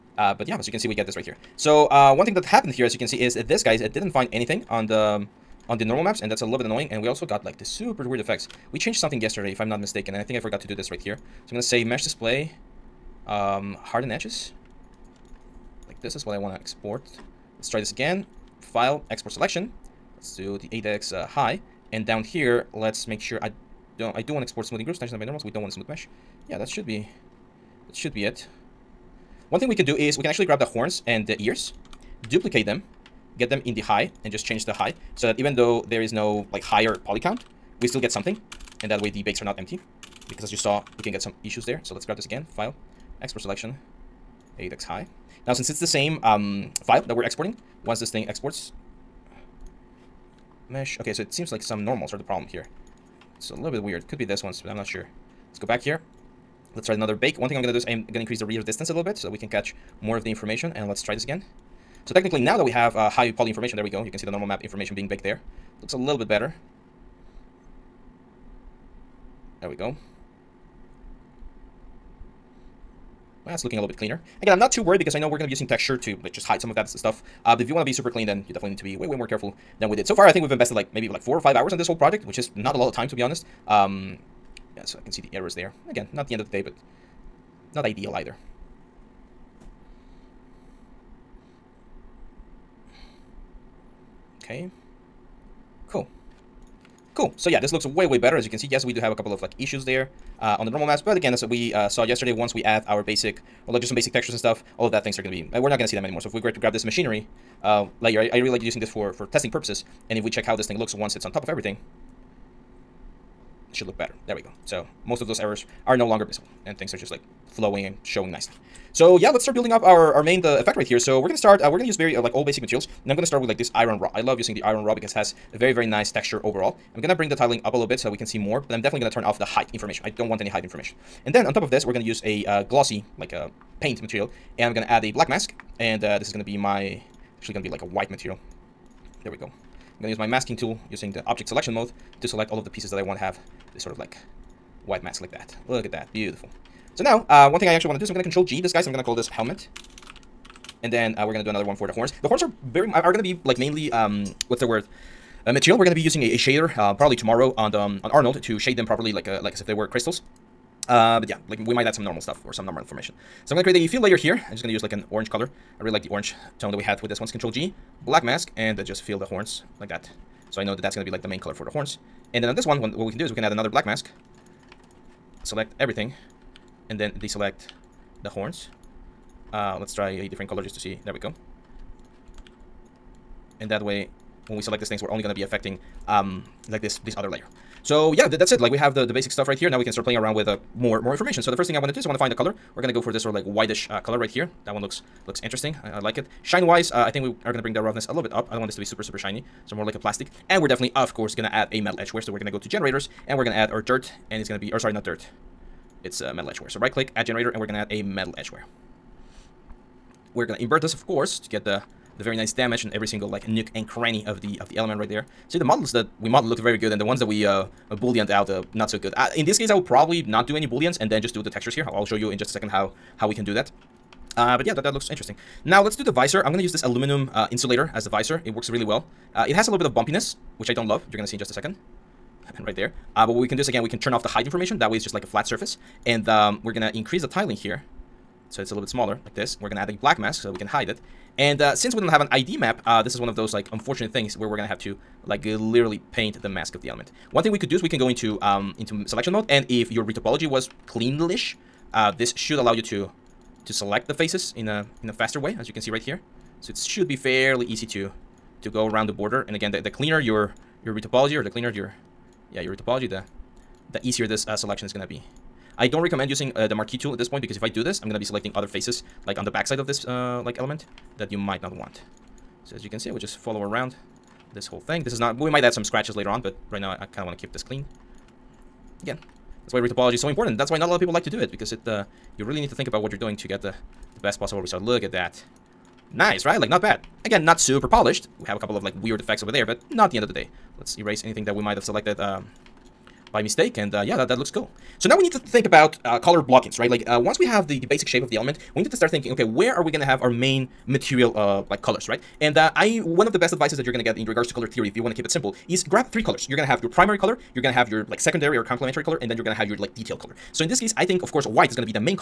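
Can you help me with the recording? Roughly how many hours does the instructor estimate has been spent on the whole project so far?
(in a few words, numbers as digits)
4 or 5 hours.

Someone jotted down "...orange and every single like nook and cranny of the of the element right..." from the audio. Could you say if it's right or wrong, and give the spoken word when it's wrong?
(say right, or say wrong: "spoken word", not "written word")
wrong: "damage", not "orange".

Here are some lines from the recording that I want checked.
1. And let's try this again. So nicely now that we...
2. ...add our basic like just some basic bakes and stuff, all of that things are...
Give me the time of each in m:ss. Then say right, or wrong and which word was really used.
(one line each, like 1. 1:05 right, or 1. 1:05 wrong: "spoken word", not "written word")
1. 1:00 wrong: "technically", not "nicely"
2. 1:42 wrong: "textures", not "bakes".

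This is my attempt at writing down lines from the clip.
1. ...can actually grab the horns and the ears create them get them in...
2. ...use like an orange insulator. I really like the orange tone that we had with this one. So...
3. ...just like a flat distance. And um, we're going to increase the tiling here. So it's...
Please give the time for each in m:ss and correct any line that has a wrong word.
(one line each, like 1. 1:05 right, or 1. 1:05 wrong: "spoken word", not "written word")
1. 0:30 wrong: "duplicate", not "create"
2. 2:44 wrong: "color", not "insulator"
3. 3:55 wrong: "surface", not "distance".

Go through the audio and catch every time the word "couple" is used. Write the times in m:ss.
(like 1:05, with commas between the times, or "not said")
1:39, 4:48.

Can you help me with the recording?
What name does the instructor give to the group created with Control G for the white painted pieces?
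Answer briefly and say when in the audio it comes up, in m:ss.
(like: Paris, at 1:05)
Helmet, at 2:29.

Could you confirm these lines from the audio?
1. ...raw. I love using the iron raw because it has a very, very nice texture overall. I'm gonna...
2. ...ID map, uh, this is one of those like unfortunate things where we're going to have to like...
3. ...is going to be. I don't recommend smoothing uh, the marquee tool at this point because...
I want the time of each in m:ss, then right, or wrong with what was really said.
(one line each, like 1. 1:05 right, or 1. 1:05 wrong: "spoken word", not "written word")
1. 2:03 right
2. 4:02 right
3. 4:24 wrong: "using", not "smoothing".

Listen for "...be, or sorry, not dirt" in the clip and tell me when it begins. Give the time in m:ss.
3:24.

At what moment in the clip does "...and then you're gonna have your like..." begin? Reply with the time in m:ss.
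5:09.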